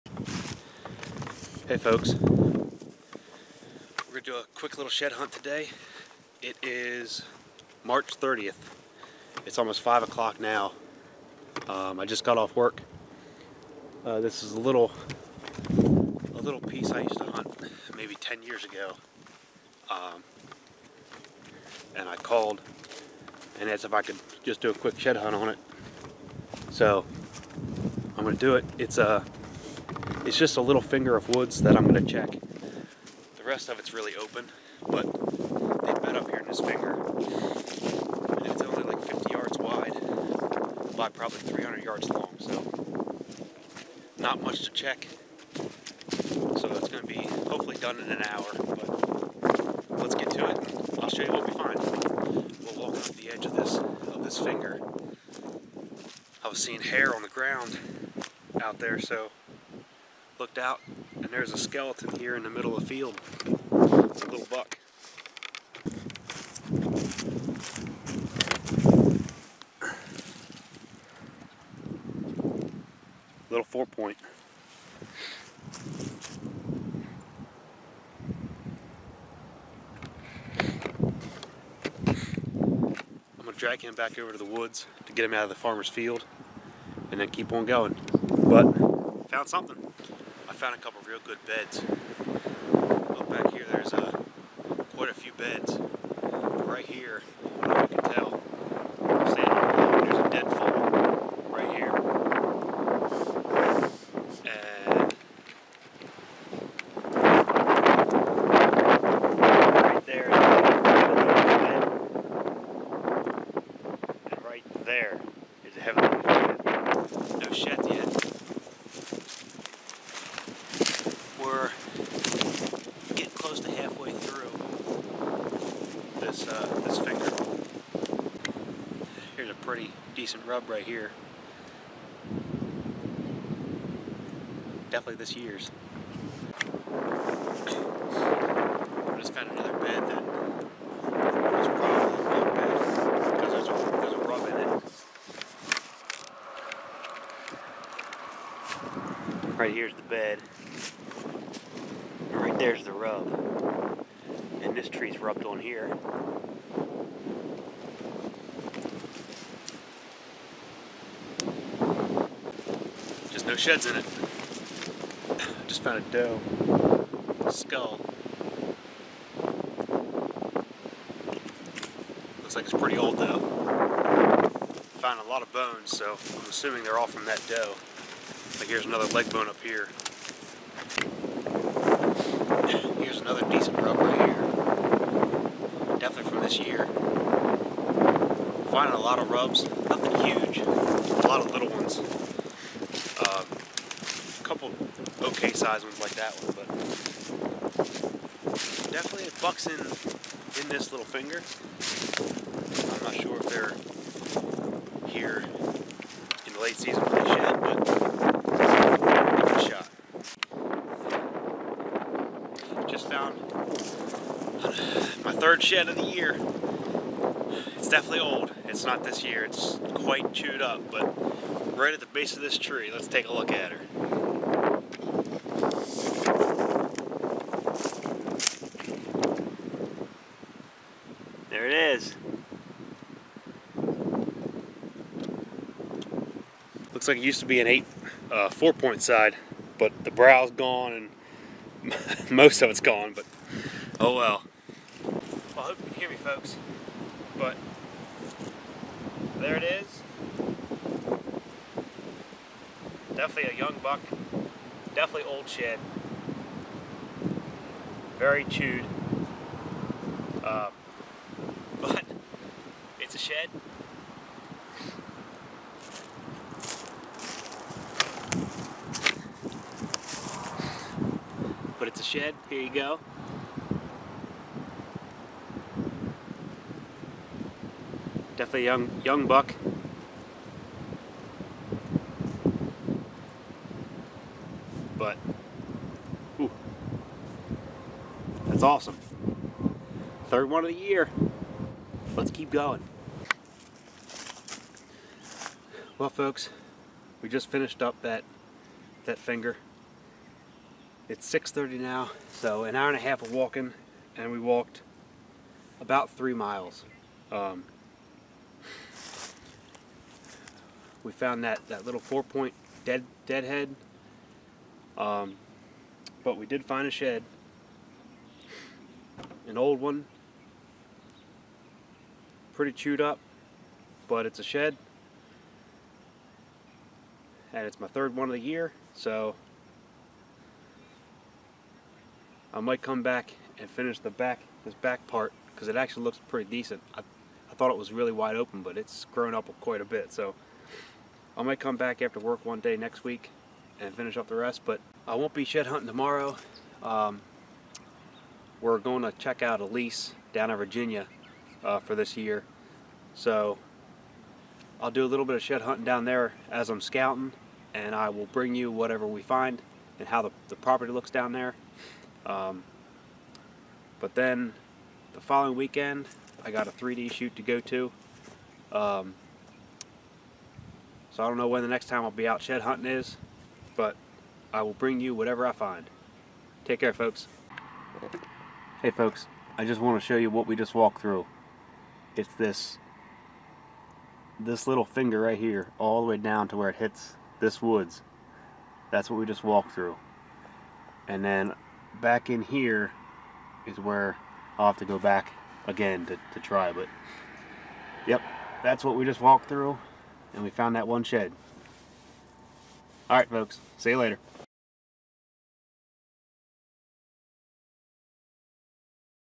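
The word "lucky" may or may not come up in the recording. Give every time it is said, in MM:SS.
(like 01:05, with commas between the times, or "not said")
not said.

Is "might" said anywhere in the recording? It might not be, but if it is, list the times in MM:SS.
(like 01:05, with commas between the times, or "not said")
05:32, 05:41.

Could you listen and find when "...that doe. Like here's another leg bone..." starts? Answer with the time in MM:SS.
02:57.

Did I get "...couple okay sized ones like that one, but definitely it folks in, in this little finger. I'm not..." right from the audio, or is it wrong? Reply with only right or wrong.
wrong.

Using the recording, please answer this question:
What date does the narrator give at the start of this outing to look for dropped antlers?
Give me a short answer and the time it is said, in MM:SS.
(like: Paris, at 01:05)
March 30th, at 00:07.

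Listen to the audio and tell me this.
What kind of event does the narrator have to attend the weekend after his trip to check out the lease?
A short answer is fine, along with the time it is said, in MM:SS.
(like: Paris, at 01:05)
A 3D shoot, at 06:06.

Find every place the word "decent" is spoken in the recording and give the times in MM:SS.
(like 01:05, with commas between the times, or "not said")
02:10, 03:03, 05:36.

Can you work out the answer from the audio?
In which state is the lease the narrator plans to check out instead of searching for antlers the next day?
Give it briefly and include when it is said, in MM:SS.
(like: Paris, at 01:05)
Virginia, at 05:50.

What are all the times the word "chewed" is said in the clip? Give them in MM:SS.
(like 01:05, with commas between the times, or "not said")
03:40, 04:18, 05:22.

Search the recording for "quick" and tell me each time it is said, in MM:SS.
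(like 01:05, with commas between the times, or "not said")
00:04, 00:24.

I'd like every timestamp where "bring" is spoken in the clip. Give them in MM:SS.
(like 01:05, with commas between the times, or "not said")
05:58, 06:14.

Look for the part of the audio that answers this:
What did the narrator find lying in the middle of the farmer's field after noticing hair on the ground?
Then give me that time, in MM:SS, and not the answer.
01:01.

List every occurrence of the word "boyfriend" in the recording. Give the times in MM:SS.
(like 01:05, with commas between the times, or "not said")
not said.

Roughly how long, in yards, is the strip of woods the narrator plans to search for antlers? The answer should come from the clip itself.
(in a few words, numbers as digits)
300 yards.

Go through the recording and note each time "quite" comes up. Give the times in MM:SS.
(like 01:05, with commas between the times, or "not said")
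01:34, 03:39, 05:39.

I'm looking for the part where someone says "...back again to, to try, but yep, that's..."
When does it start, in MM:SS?
06:34.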